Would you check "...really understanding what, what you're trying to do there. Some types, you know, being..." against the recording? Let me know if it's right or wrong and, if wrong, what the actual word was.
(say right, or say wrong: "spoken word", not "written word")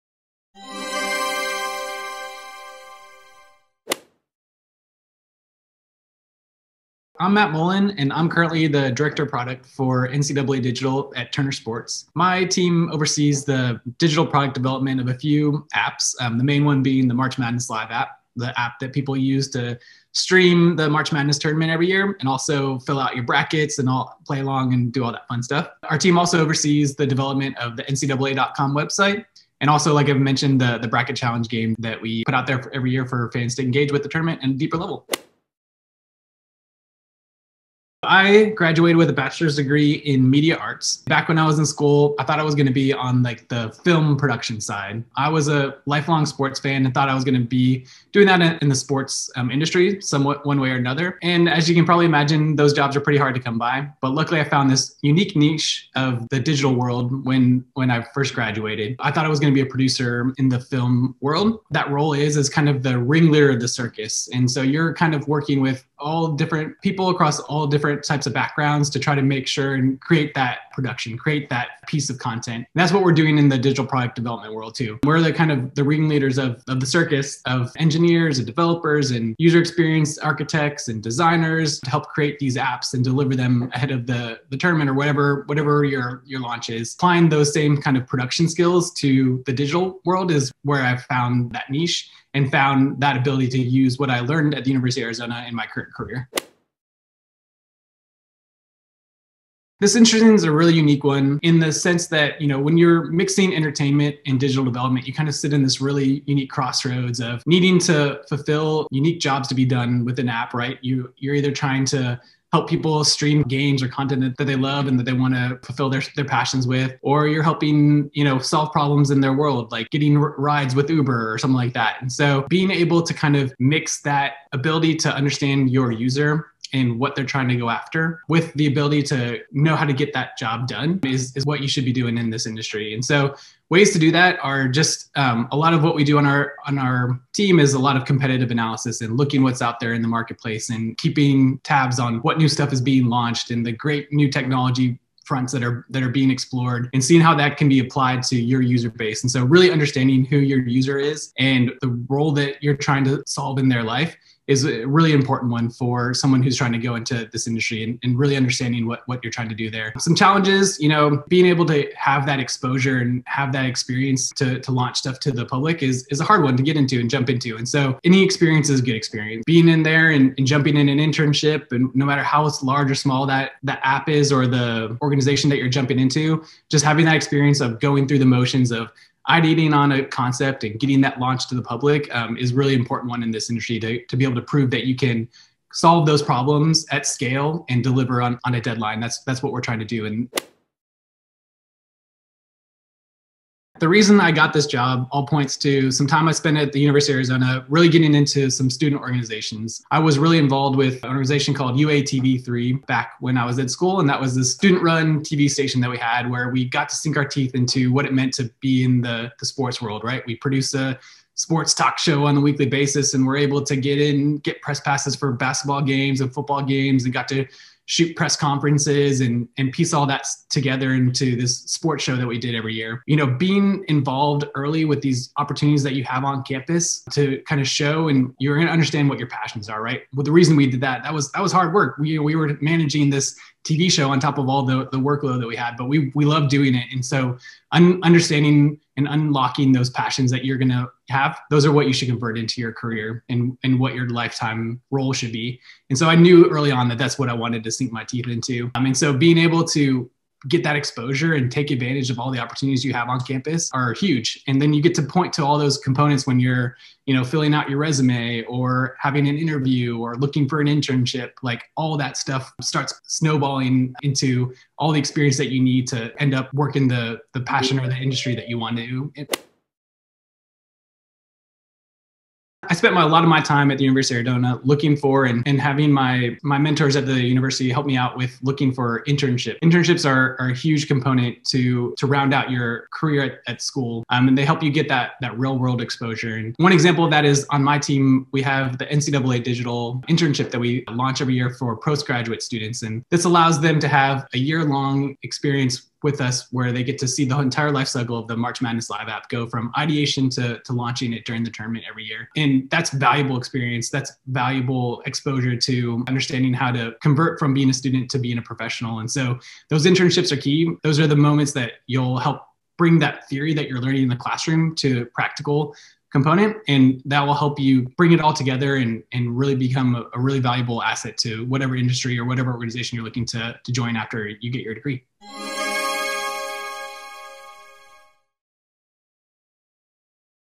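wrong: "challenges", not "types".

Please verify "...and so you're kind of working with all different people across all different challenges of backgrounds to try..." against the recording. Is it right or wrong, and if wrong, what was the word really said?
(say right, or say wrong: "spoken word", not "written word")
wrong: "types", not "challenges".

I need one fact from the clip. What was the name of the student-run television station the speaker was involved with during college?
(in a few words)
UATV3.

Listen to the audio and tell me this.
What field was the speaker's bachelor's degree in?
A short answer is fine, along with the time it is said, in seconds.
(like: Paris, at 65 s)
Media arts, at 40 s.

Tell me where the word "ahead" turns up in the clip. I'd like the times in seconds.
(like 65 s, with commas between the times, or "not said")
83 s.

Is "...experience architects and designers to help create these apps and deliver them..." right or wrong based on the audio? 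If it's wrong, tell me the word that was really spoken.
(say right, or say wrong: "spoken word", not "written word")
right.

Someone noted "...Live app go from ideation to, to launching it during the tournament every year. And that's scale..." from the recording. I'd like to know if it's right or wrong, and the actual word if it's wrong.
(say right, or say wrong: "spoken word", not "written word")
wrong: "valuable", not "scale".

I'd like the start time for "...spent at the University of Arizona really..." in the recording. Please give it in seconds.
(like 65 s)
196 s.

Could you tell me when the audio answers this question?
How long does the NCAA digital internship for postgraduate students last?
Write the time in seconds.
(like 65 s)
294 s.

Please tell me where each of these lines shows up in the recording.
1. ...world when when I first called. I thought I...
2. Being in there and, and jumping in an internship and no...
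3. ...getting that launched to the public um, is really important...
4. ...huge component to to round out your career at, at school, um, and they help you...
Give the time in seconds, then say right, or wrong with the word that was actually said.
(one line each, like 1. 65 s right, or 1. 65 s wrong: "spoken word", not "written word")
1. 56 s wrong: "graduated", not "called"
2. 169 s right
3. 180 s right
4. 280 s right.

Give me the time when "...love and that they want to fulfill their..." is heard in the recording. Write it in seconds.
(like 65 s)
114 s.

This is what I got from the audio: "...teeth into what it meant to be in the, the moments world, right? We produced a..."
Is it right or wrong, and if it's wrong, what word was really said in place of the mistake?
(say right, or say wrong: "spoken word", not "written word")
wrong: "sports", not "moments".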